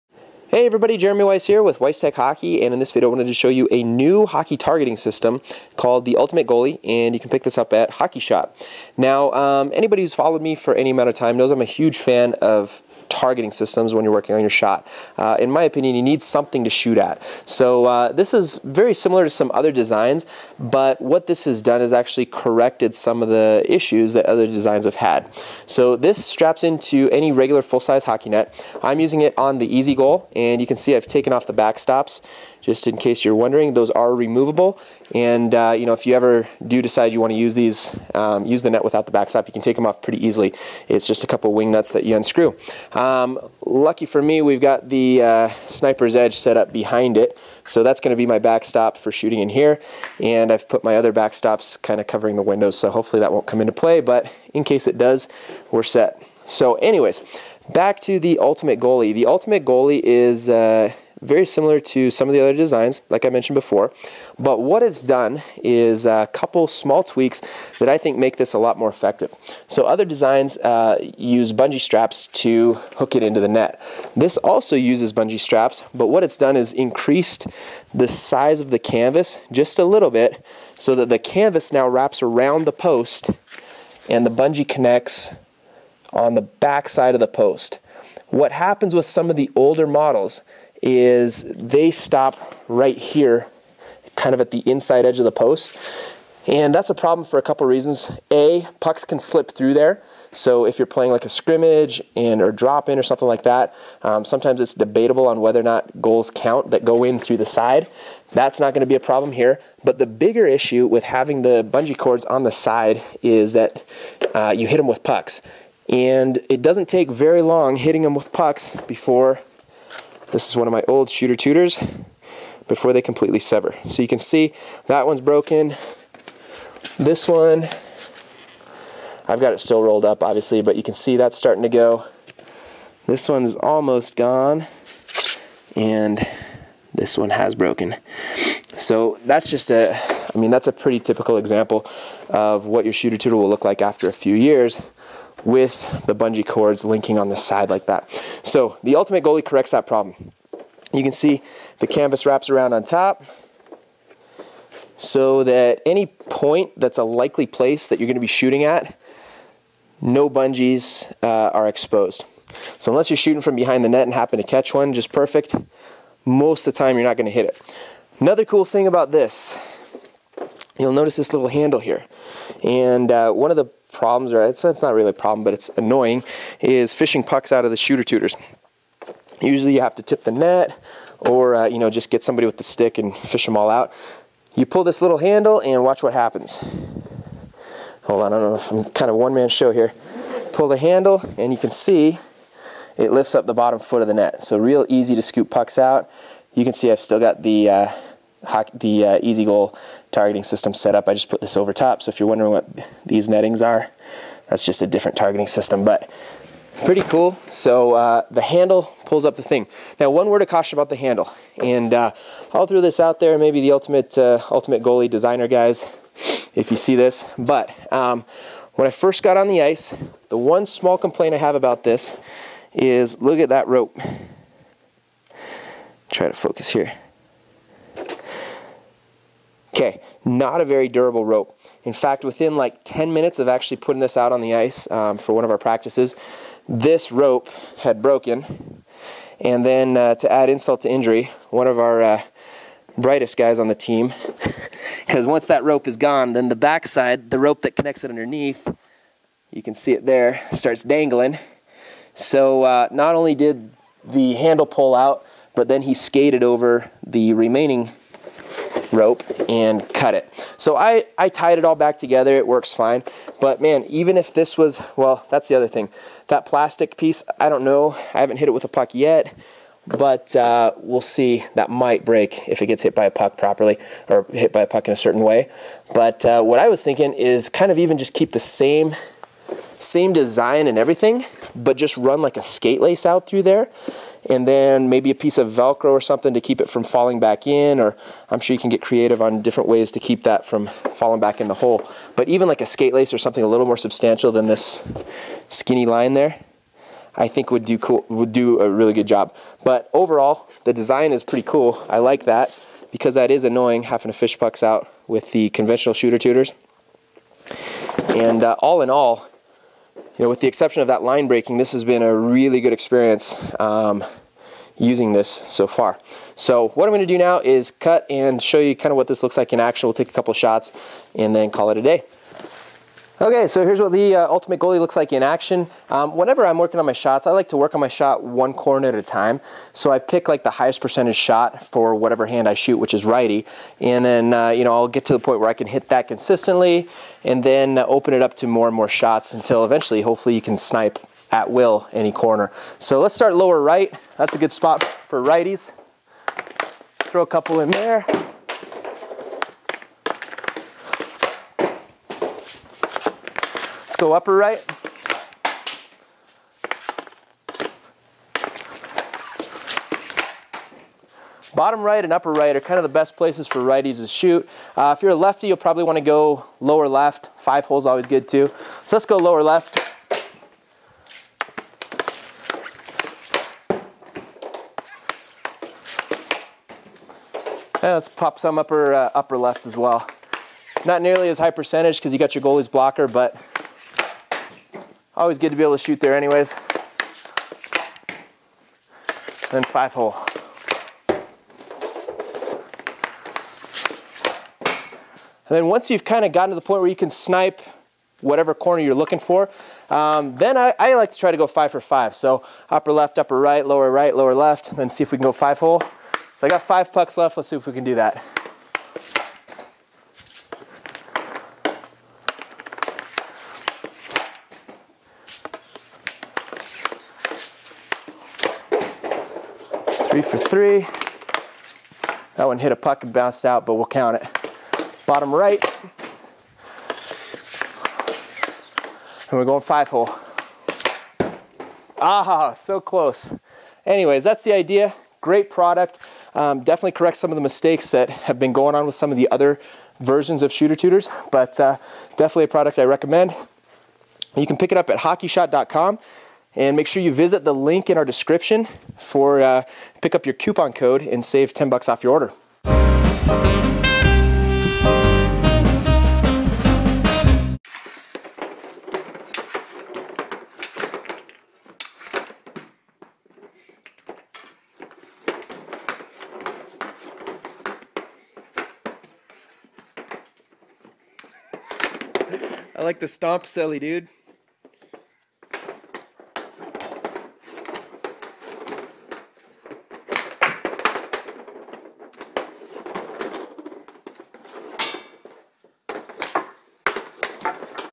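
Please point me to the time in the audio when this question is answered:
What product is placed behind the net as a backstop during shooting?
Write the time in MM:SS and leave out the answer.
00:45.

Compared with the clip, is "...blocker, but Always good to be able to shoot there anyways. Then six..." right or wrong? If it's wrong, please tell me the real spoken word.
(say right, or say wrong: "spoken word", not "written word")
wrong: "five", not "six".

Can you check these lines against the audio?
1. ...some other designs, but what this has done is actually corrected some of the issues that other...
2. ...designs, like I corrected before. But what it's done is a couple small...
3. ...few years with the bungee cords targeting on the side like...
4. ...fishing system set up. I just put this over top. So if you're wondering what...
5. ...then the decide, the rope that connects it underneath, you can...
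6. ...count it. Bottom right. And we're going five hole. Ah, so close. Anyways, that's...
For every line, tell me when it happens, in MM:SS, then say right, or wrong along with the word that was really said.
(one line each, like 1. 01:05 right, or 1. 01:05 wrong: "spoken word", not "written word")
1. 00:19 right
2. 01:02 wrong: "mentioned", not "corrected"
3. 02:24 wrong: "linking", not "targeting"
4. 03:20 wrong: "targeting", not "fishing"
5. 04:06 wrong: "backside", not "decide"
6. 07:03 right.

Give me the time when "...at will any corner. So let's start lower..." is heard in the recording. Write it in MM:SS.
05:41.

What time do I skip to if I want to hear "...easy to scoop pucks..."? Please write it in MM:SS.
03:14.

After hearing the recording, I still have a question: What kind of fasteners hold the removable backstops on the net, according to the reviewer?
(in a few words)
wing nuts.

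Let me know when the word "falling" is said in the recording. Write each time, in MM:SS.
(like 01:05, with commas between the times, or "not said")
04:46, 04:50.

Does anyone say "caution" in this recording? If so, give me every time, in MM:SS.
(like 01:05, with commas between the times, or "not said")
03:30.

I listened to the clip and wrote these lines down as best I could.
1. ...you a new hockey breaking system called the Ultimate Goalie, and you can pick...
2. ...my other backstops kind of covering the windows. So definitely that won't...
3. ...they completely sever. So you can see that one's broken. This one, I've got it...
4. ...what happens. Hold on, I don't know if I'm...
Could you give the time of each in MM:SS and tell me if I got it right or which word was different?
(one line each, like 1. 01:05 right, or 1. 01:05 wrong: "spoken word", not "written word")
1. 00:03 wrong: "targeting", not "breaking"
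2. 00:50 wrong: "hopefully", not "definitely"
3. 02:02 right
4. 03:06 right.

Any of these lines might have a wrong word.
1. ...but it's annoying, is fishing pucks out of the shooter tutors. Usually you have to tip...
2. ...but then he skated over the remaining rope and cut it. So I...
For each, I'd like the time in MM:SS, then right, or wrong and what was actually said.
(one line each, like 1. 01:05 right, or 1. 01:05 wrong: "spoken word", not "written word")
1. 02:55 right
2. 04:15 right.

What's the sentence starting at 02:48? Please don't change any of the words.
Another cool thing about this, you'll notice this little handle here.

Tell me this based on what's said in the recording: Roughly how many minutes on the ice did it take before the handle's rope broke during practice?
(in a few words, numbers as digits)
10 minutes.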